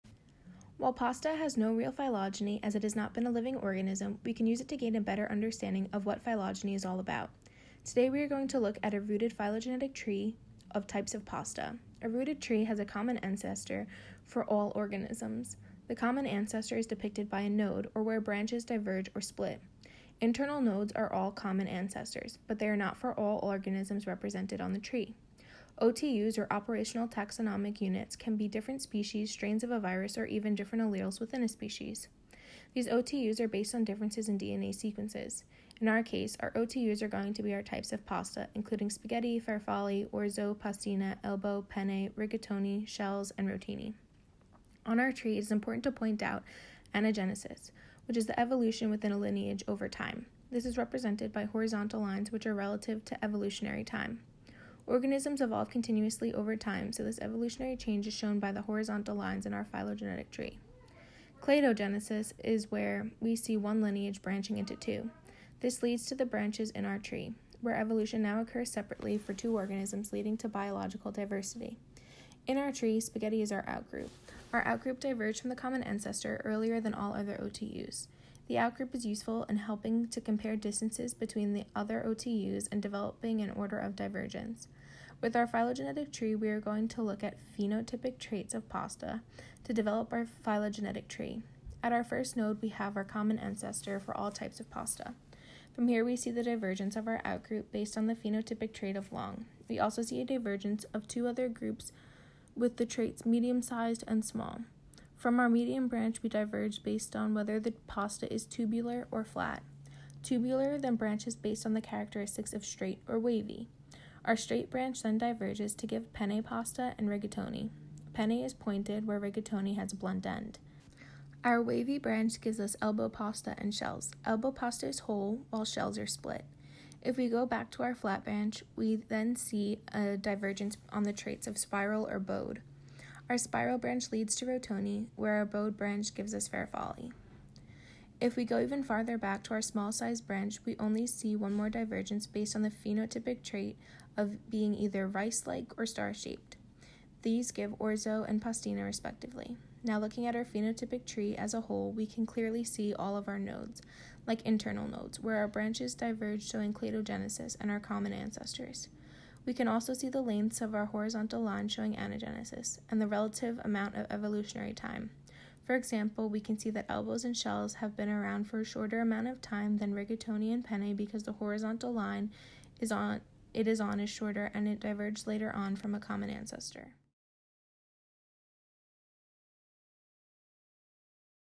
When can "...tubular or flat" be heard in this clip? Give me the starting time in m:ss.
1:48.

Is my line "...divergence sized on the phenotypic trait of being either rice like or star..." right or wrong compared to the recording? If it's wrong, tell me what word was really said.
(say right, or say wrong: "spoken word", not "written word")
wrong: "based", not "sized".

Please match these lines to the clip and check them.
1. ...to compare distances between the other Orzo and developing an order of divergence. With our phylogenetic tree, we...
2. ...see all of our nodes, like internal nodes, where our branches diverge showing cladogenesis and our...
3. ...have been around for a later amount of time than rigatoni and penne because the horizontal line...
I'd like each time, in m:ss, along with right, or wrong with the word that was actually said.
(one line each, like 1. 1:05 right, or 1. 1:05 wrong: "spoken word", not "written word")
1. 1:20 wrong: "OTUs", not "Orzo"
2. 2:32 right
3. 2:47 wrong: "shorter", not "later".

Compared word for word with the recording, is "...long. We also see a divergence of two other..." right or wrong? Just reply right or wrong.
right.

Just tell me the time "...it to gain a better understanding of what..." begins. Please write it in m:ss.
0:04.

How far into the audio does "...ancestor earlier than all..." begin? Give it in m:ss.
1:15.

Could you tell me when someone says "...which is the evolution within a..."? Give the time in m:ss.
0:48.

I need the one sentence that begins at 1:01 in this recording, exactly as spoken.
Cladogenesis is where we see one lineage branching into two.